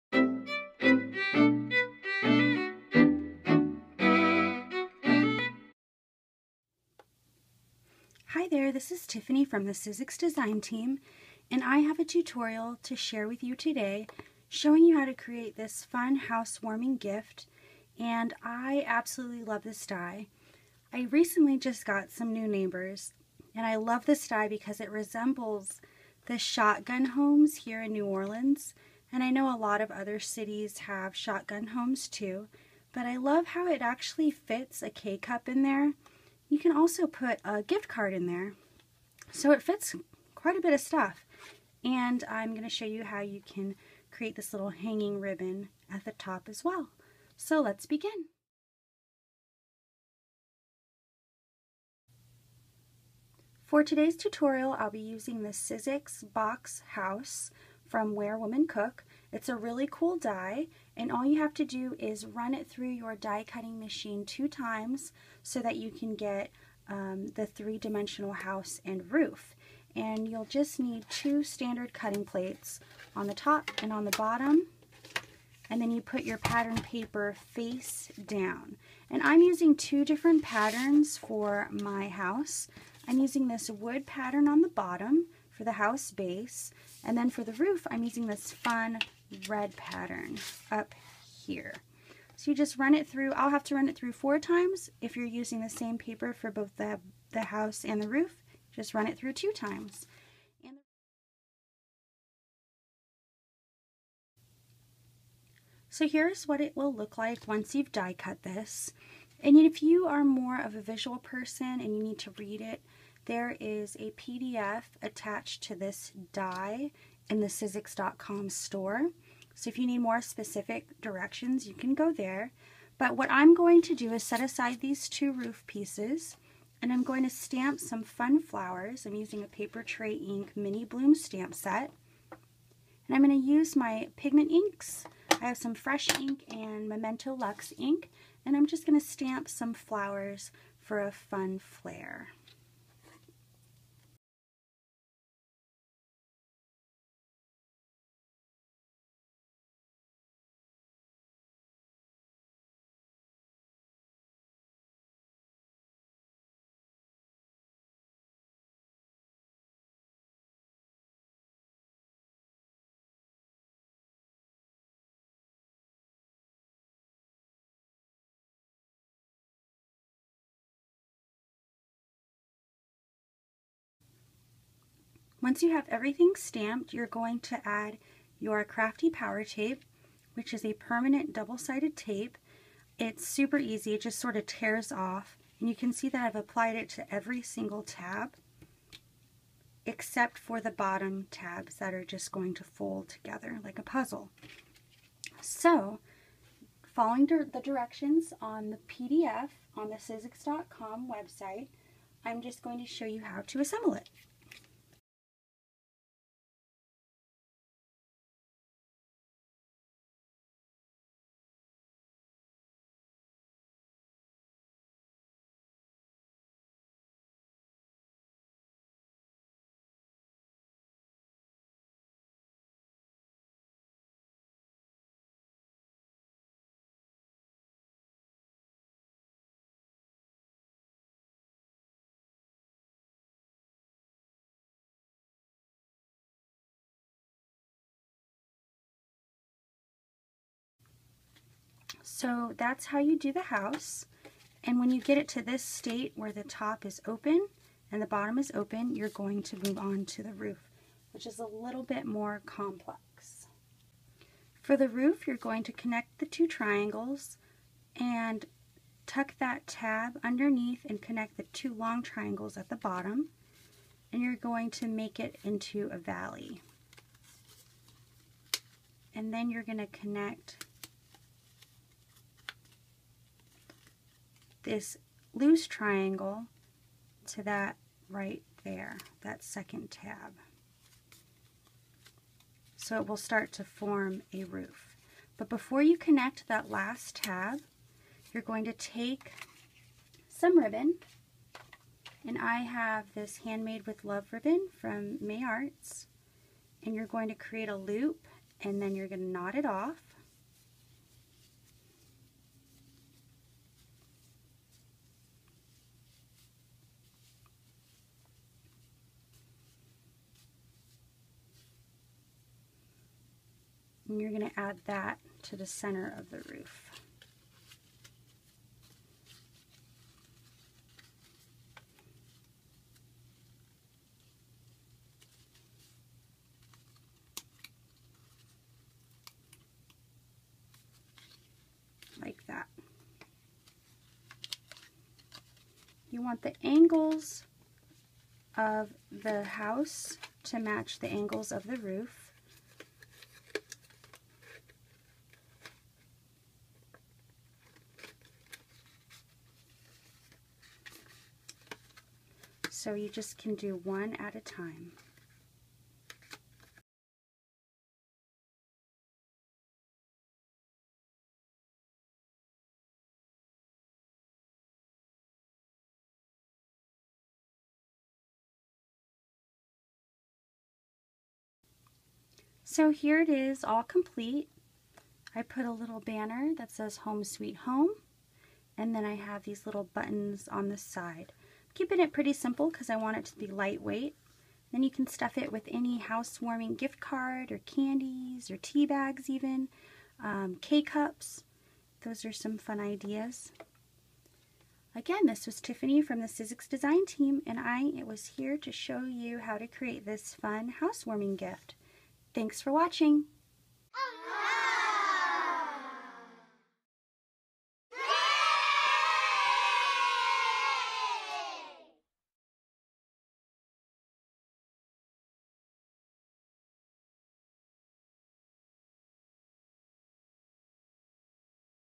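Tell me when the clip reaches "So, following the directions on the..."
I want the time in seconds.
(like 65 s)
195 s.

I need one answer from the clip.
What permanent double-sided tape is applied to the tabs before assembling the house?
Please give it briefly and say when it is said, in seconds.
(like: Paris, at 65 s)
Crafty Power Tape, at 178 s.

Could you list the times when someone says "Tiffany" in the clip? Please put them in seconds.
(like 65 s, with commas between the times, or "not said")
9 s, 395 s.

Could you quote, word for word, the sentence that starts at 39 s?
So it fits quite a bit of stuff.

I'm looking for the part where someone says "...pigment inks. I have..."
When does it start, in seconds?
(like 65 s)
134 s.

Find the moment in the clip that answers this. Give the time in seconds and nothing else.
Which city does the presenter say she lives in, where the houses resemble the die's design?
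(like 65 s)
27 s.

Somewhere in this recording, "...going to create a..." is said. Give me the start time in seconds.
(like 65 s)
297 s.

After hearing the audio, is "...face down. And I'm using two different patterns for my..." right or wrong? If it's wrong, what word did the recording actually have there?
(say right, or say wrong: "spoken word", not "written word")
right.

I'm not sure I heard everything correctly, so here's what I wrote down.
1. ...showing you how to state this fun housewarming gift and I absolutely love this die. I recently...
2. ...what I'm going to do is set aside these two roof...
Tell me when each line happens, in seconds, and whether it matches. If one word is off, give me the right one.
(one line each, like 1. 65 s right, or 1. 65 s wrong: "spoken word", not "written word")
1. 14 s wrong: "create", not "state"
2. 123 s right.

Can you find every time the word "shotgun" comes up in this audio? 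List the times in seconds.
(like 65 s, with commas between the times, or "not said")
26 s, 31 s.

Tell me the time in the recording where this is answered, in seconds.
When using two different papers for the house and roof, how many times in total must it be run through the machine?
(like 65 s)
94 s.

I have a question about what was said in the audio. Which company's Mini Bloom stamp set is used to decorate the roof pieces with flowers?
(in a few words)
Papertrey Ink.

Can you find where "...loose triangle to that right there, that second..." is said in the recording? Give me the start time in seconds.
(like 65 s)
275 s.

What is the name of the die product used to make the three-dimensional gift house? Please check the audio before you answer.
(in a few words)
Box House.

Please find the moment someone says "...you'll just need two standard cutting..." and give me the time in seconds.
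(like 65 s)
70 s.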